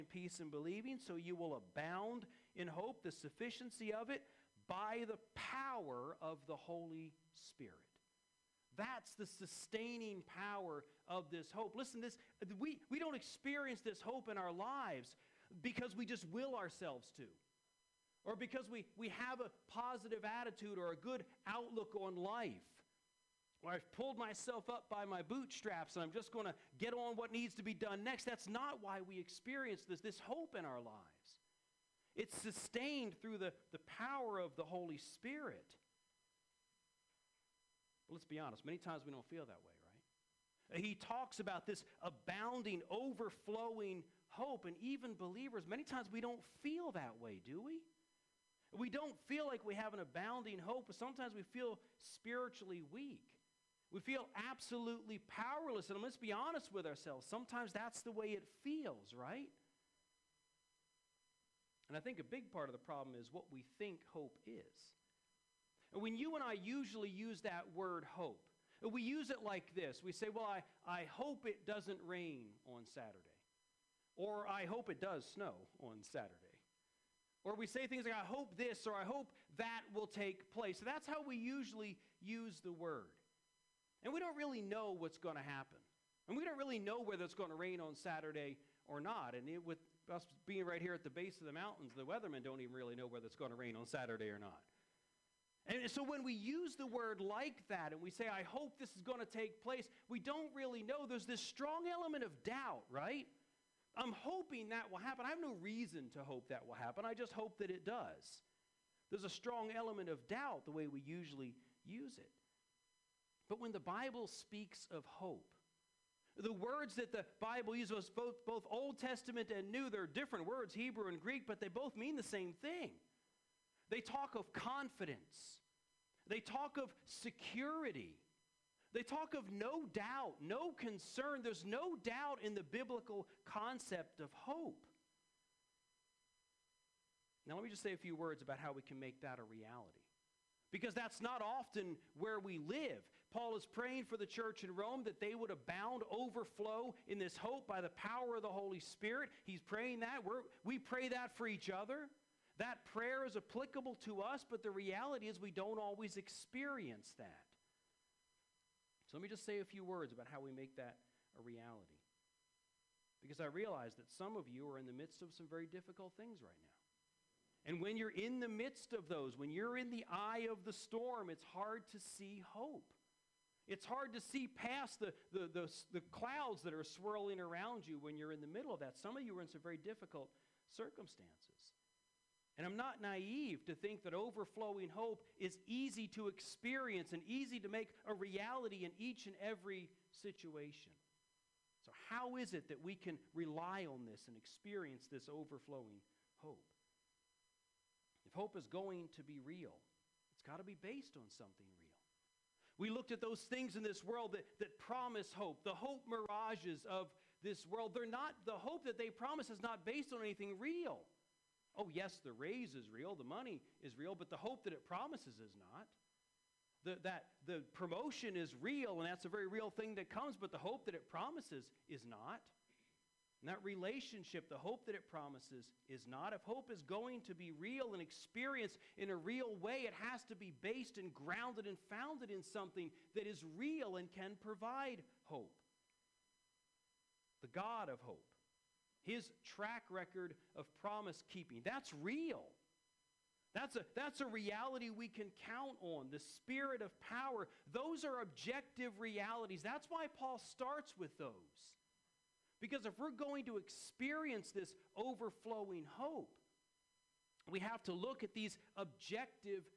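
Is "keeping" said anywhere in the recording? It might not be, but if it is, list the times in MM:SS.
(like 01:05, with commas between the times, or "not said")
04:01.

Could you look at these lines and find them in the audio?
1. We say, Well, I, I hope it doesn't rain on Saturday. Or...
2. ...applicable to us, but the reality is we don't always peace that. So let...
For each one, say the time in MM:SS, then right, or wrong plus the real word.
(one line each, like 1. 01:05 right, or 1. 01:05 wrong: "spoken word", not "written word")
1. 01:10 right
2. 02:33 wrong: "experience", not "peace".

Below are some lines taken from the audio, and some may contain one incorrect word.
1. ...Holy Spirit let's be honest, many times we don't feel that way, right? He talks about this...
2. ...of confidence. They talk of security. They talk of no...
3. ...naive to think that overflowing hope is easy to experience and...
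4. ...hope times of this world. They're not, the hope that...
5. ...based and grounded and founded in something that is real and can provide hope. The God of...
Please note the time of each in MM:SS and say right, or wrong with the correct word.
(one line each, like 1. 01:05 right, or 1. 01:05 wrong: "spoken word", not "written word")
1. 00:34 right
2. 02:04 right
3. 03:03 right
4. 03:25 wrong: "mirages", not "times"
5. 03:50 right.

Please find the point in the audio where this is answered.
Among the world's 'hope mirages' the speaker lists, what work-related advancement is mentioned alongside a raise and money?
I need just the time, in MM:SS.
03:37.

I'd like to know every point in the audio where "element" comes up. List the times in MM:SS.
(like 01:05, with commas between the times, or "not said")
01:41, 01:49.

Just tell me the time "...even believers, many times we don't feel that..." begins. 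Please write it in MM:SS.
00:44.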